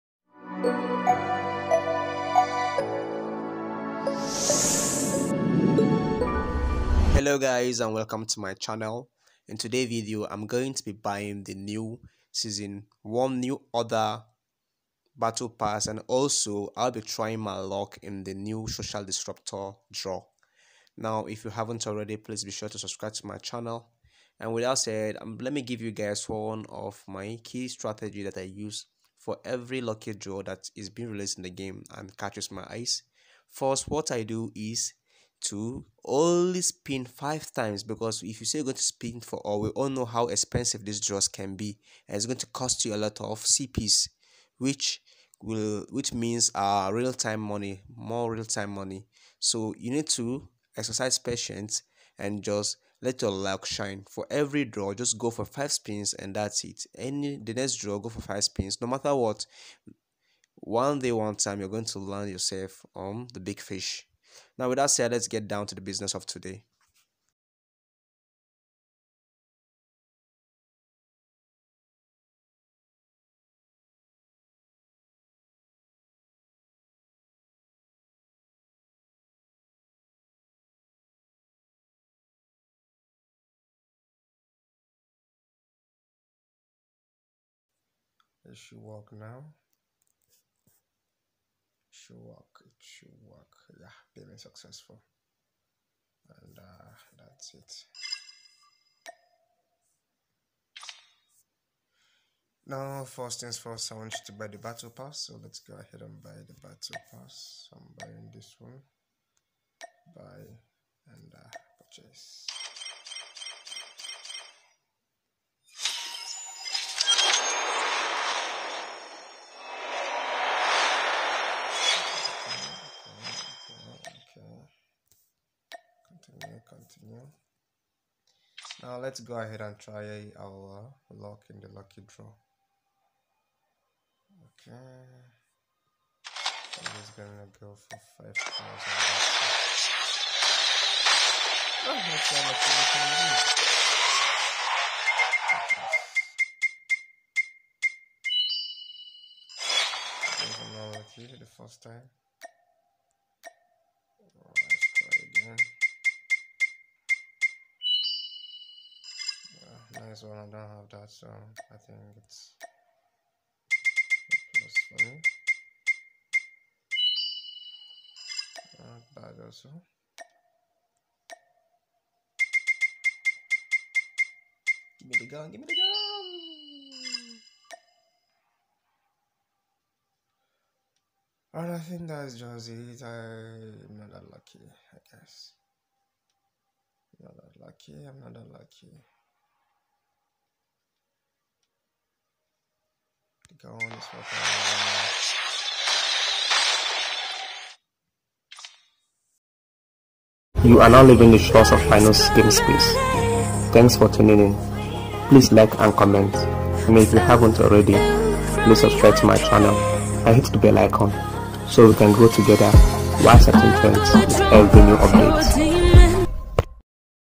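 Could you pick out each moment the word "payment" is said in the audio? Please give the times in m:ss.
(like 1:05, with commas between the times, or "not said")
1:34.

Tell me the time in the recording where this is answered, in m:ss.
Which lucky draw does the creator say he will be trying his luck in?
0:18.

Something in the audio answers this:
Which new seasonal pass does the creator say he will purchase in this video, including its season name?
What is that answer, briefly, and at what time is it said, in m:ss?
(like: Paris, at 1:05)
Season one New Order battle pass, at 0:12.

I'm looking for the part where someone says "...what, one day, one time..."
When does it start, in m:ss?
0:59.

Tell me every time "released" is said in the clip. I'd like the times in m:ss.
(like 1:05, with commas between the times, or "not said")
0:31.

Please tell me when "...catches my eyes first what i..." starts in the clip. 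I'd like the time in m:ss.
0:32.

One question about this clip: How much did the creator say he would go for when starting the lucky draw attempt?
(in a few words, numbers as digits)
5000.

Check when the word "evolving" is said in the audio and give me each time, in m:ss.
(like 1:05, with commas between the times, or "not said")
not said.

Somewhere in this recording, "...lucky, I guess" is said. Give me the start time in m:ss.
3:04.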